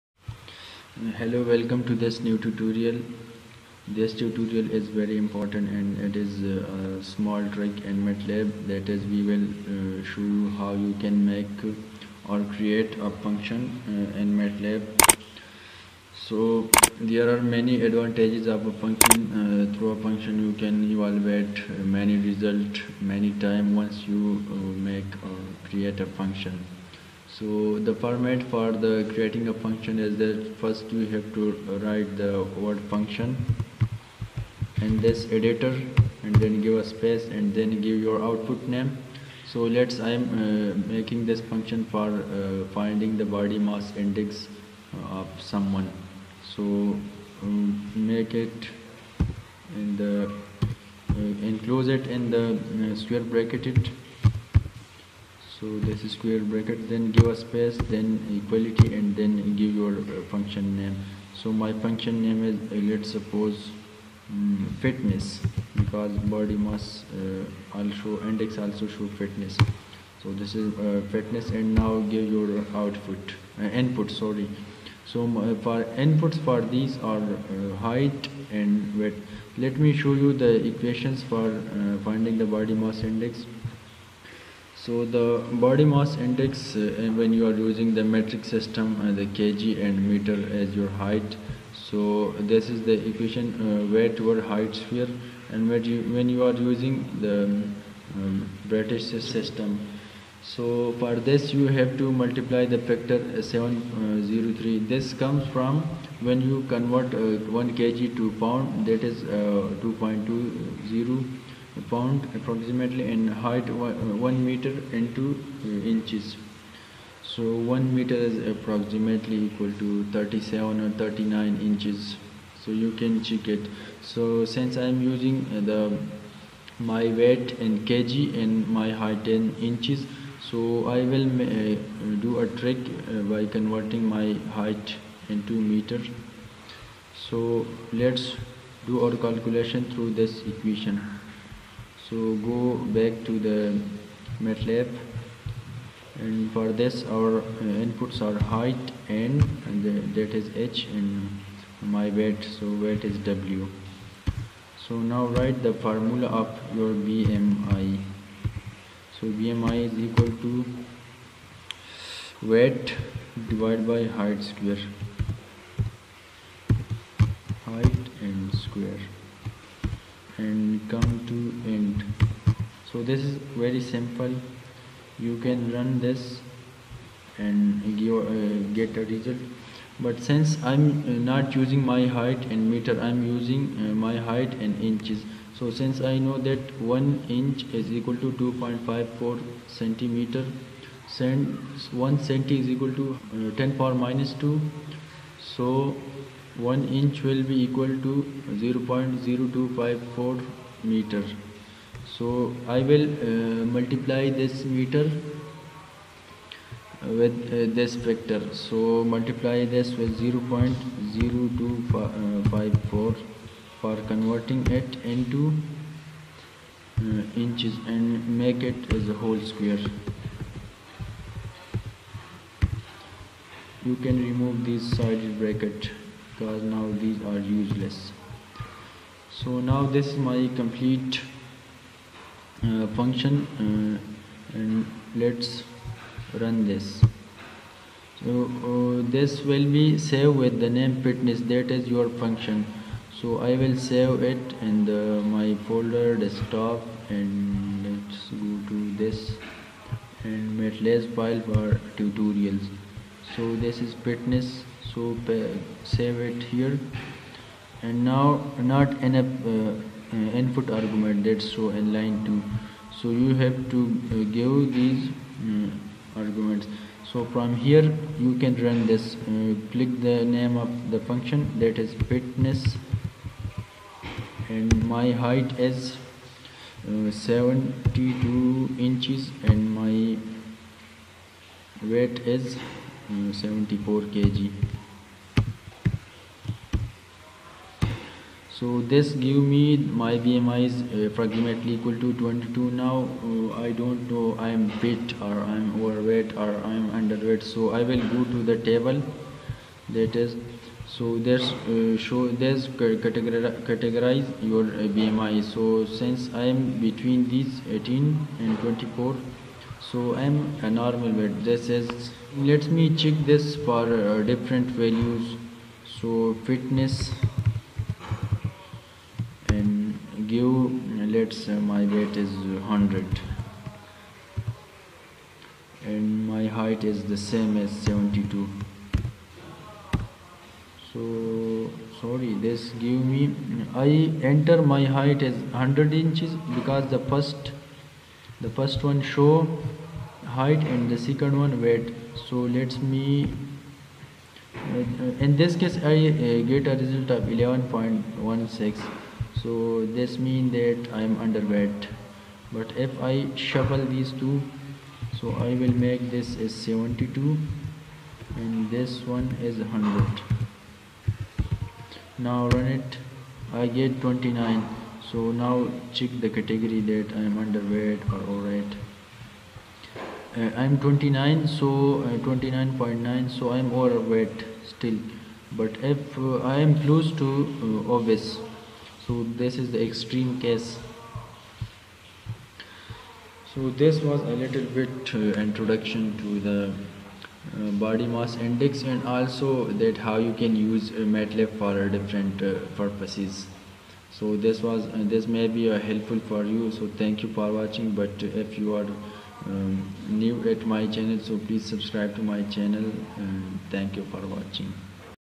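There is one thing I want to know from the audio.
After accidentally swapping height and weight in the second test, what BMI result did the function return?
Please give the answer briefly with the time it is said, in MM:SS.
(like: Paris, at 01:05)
11.16, at 05:47.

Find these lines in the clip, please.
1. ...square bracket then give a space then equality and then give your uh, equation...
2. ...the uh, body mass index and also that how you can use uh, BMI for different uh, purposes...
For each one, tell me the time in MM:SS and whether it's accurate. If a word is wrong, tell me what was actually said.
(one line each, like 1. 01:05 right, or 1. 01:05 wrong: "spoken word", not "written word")
1. 00:56 wrong: "function", not "equation"
2. 06:26 wrong: "MATLAB", not "BMI".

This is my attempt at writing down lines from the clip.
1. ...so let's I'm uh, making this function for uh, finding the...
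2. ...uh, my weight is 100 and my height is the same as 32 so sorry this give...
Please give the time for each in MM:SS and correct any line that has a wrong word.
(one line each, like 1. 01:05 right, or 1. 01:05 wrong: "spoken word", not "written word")
1. 00:39 right
2. 05:21 wrong: "72", not "32".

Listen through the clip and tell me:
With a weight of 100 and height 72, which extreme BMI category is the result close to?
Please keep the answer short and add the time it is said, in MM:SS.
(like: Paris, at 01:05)
obese, at 06:17.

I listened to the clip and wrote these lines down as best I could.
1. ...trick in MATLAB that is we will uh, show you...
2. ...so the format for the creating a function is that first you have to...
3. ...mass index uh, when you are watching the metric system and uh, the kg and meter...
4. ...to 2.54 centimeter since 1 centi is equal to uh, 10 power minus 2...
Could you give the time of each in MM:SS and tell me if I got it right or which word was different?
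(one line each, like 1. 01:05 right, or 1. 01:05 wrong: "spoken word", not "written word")
1. 00:07 right
2. 00:27 right
3. 01:25 wrong: "using", not "watching"
4. 03:08 right.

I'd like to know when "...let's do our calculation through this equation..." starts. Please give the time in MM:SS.
02:17.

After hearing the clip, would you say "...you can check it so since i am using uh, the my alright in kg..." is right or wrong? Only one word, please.
wrong.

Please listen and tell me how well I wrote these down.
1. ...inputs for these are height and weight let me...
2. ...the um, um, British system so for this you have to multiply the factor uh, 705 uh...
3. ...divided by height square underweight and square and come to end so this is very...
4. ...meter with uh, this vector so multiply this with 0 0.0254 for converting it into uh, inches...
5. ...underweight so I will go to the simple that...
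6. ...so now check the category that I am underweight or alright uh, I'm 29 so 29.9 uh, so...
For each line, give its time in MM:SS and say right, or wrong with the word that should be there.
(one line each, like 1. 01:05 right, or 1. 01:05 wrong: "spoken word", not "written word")
1. 01:16 right
2. 01:37 wrong: "703", not "705"
3. 02:43 wrong: "height", not "underweight"
4. 03:24 right
5. 04:56 wrong: "table", not "simple"
6. 06:05 right.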